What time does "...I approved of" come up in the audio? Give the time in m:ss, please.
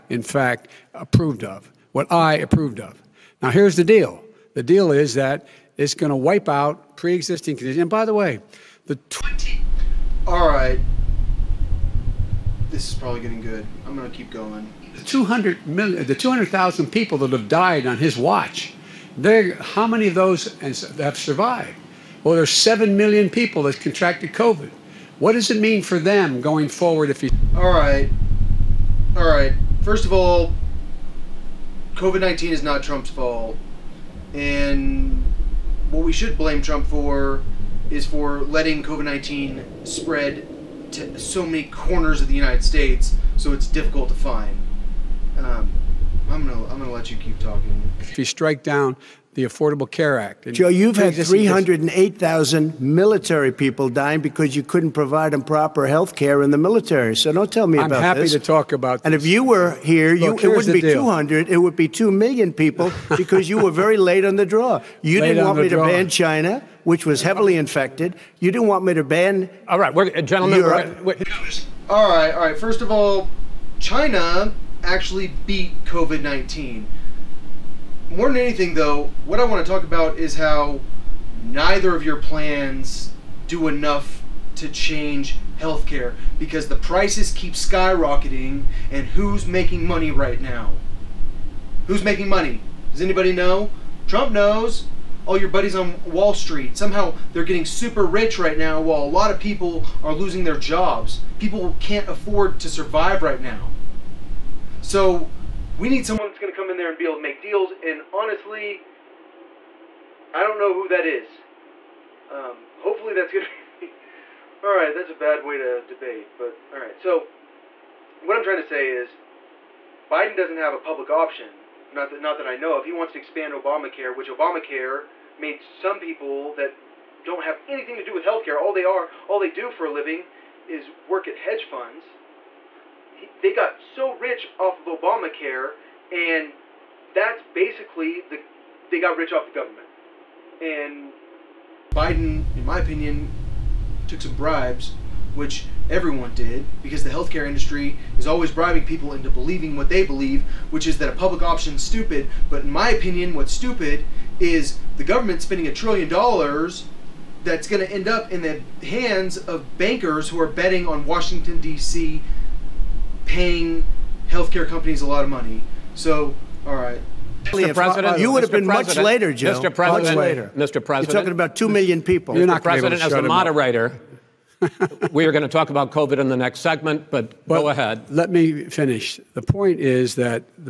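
0:02.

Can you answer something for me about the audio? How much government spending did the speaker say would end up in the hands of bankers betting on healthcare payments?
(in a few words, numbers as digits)
a trillion dollars.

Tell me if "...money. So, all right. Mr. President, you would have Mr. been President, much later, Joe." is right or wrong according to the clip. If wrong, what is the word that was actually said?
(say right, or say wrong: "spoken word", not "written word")
right.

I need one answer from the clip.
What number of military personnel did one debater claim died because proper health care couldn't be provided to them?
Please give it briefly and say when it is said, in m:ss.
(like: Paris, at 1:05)
308,000, at 0:51.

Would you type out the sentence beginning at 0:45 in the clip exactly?
Um, I'm gonna I'm gonna let you keep talking.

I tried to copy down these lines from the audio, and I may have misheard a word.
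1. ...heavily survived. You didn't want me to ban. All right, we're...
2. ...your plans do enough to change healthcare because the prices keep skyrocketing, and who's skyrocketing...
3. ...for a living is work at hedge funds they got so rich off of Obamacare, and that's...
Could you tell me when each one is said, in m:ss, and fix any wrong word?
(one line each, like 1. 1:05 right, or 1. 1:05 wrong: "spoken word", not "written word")
1. 1:07 wrong: "infected", not "survived"
2. 1:22 wrong: "making", not "skyrocketing"
3. 2:09 right.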